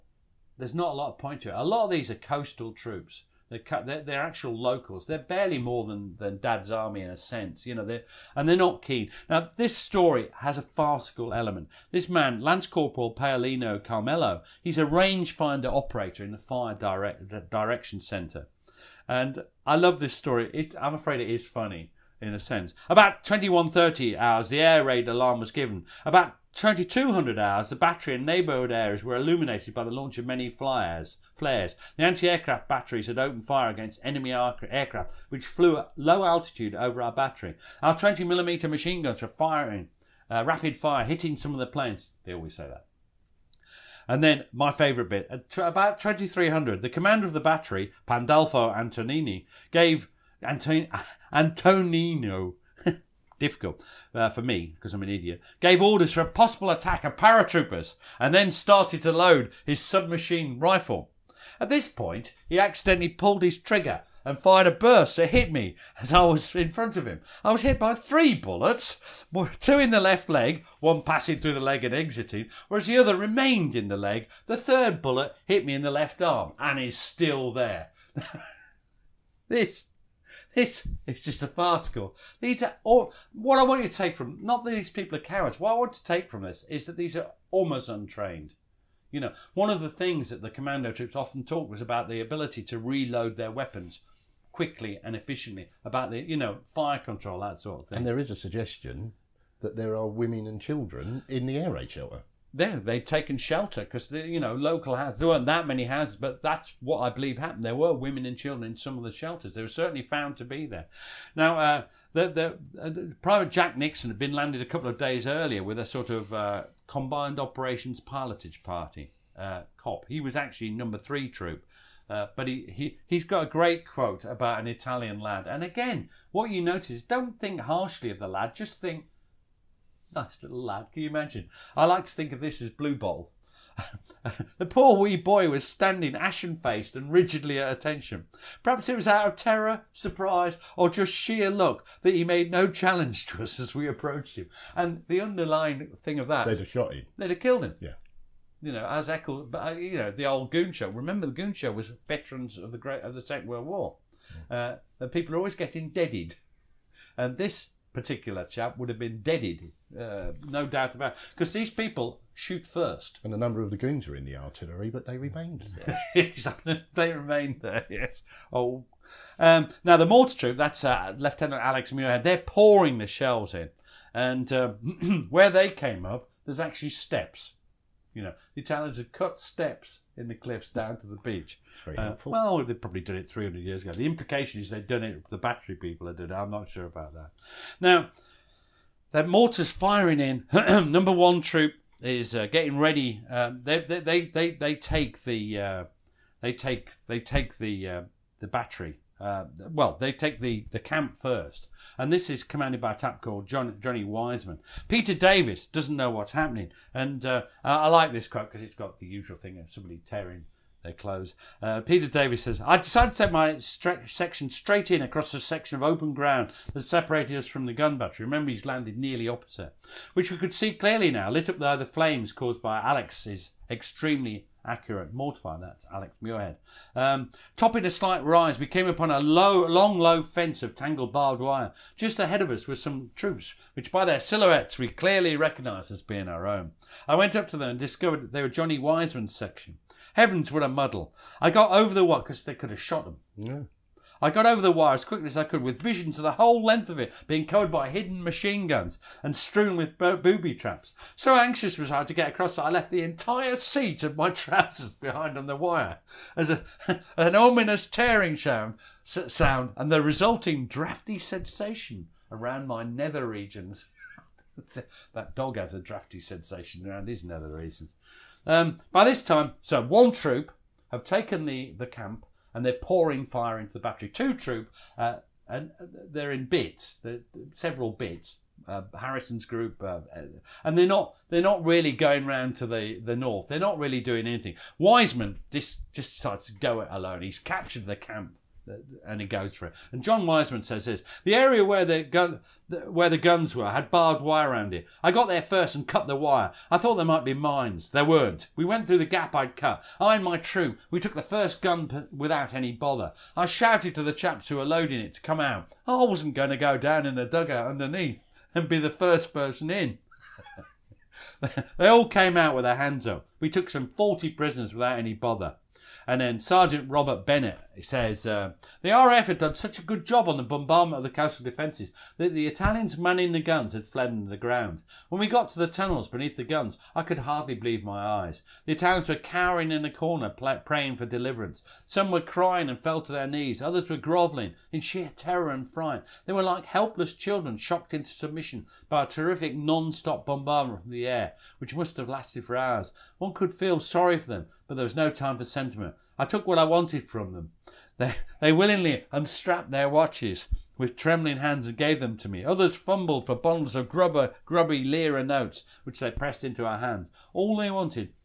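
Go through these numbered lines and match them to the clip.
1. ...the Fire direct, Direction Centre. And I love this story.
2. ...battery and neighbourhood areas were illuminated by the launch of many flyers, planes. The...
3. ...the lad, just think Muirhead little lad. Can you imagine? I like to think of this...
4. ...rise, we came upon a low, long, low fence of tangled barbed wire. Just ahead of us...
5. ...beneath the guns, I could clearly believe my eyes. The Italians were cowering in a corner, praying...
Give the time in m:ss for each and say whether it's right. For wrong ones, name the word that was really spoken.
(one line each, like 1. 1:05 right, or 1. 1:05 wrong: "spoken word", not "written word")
1. 0:16 right
2. 0:27 wrong: "flares", not "planes"
3. 2:08 wrong: "Nice", not "Muirhead"
4. 3:48 right
5. 5:26 wrong: "hardly", not "clearly".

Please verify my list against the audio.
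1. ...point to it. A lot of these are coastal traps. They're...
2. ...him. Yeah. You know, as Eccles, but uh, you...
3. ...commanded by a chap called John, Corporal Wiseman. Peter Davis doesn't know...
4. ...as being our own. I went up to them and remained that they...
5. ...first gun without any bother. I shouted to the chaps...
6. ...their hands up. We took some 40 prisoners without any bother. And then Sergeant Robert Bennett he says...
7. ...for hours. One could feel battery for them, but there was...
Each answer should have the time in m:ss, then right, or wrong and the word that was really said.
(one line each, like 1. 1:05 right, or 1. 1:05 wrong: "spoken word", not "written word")
1. 0:01 wrong: "troops", not "traps"
2. 2:27 right
3. 3:22 wrong: "Johnny", not "Corporal"
4. 3:55 wrong: "discovered", not "remained"
5. 5:01 right
6. 5:12 right
7. 5:42 wrong: "sorry", not "battery".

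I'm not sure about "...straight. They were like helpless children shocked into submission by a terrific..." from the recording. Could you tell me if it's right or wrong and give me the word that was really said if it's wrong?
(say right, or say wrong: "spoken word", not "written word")
wrong: "fright", not "straight".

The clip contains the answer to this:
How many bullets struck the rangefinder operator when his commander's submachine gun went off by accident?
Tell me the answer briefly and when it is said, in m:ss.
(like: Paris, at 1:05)
3, at 1:07.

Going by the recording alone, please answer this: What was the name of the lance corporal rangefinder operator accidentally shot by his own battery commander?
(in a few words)
Paolino Carmelo.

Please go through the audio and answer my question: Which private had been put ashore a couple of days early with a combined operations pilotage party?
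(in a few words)
Jack Nixon.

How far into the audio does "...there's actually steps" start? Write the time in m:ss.
2:56.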